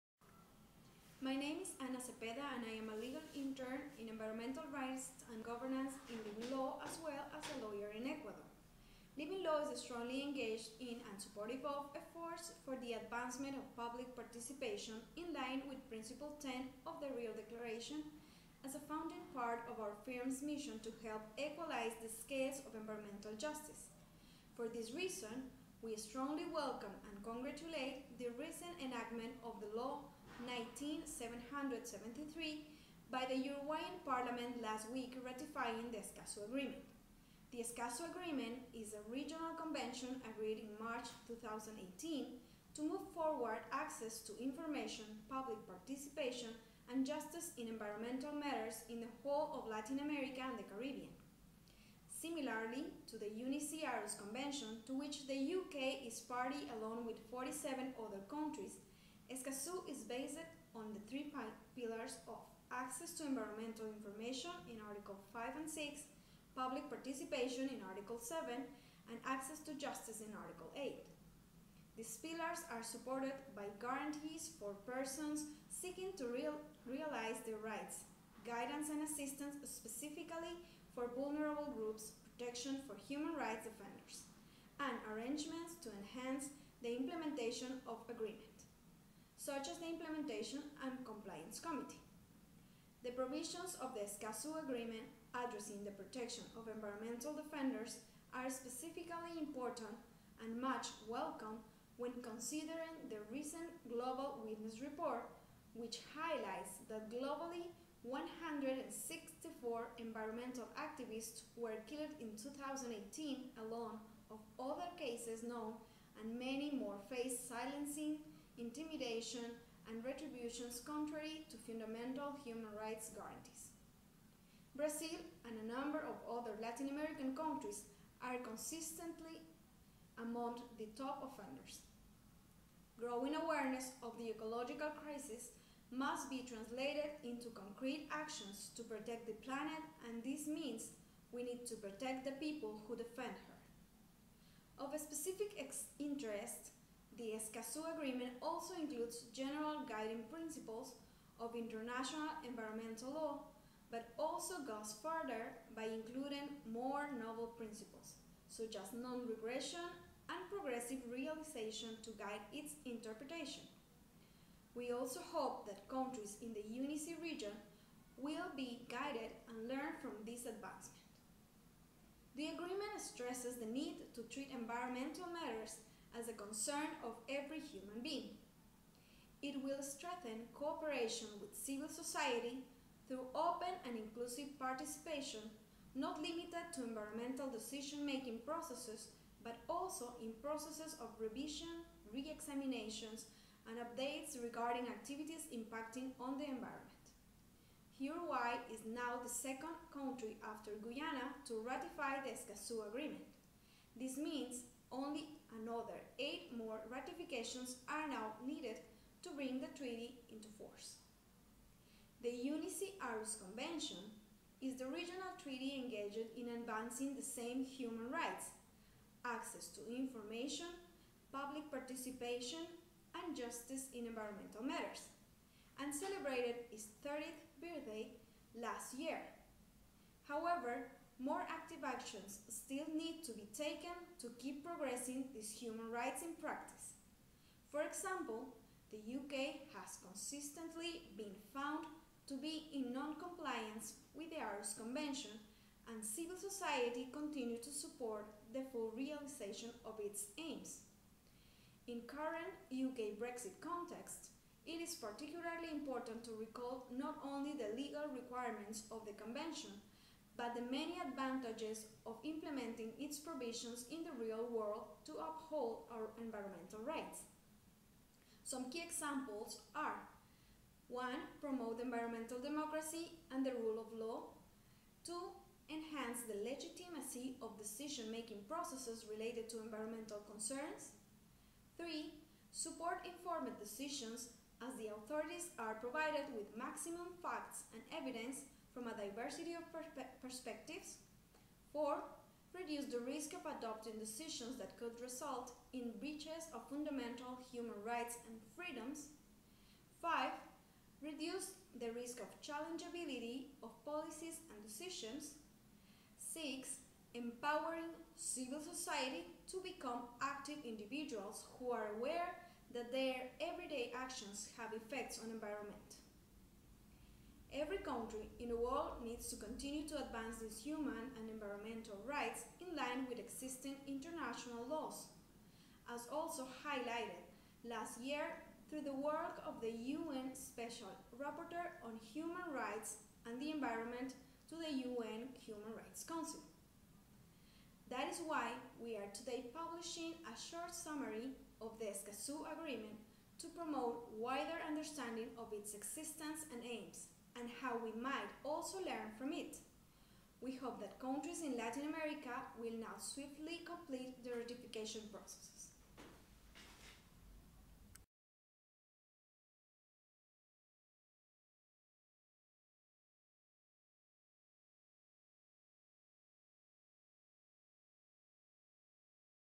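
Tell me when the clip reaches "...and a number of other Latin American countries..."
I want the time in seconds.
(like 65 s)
125 s.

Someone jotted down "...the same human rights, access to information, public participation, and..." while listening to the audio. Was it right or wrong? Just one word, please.
right.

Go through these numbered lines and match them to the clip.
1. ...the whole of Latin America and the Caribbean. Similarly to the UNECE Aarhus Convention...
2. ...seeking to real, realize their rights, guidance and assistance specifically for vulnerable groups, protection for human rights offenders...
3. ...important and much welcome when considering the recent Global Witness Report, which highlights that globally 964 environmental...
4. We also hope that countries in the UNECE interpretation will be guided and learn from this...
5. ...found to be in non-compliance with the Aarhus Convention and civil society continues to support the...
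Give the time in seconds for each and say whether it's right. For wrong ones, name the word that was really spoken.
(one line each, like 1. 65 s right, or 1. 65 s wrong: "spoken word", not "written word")
1. 49 s right
2. 75 s right
3. 99 s wrong: "164", not "964"
4. 164 s wrong: "region", not "interpretation"
5. 241 s right.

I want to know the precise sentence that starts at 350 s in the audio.
We hope that countries in Latin America will now swiftly complete the ratification processes.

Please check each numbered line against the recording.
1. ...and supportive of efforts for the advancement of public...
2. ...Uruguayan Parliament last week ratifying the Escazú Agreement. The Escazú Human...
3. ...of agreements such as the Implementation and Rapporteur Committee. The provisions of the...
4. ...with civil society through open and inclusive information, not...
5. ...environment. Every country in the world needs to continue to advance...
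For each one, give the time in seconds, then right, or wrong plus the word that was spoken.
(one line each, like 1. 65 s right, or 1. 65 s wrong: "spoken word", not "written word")
1. 10 s right
2. 33 s wrong: "Agreement", not "Human"
3. 87 s wrong: "Compliance", not "Rapporteur"
4. 181 s wrong: "participation", not "information"
5. 315 s right.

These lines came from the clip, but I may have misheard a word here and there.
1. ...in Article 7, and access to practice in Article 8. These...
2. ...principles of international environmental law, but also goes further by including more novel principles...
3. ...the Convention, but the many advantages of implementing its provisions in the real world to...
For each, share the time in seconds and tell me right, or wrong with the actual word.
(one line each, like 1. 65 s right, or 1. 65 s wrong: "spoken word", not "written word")
1. 67 s wrong: "justice", not "practice"
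2. 150 s right
3. 259 s right.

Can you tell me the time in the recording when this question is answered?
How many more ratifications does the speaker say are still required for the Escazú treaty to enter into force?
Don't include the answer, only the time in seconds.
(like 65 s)
206 s.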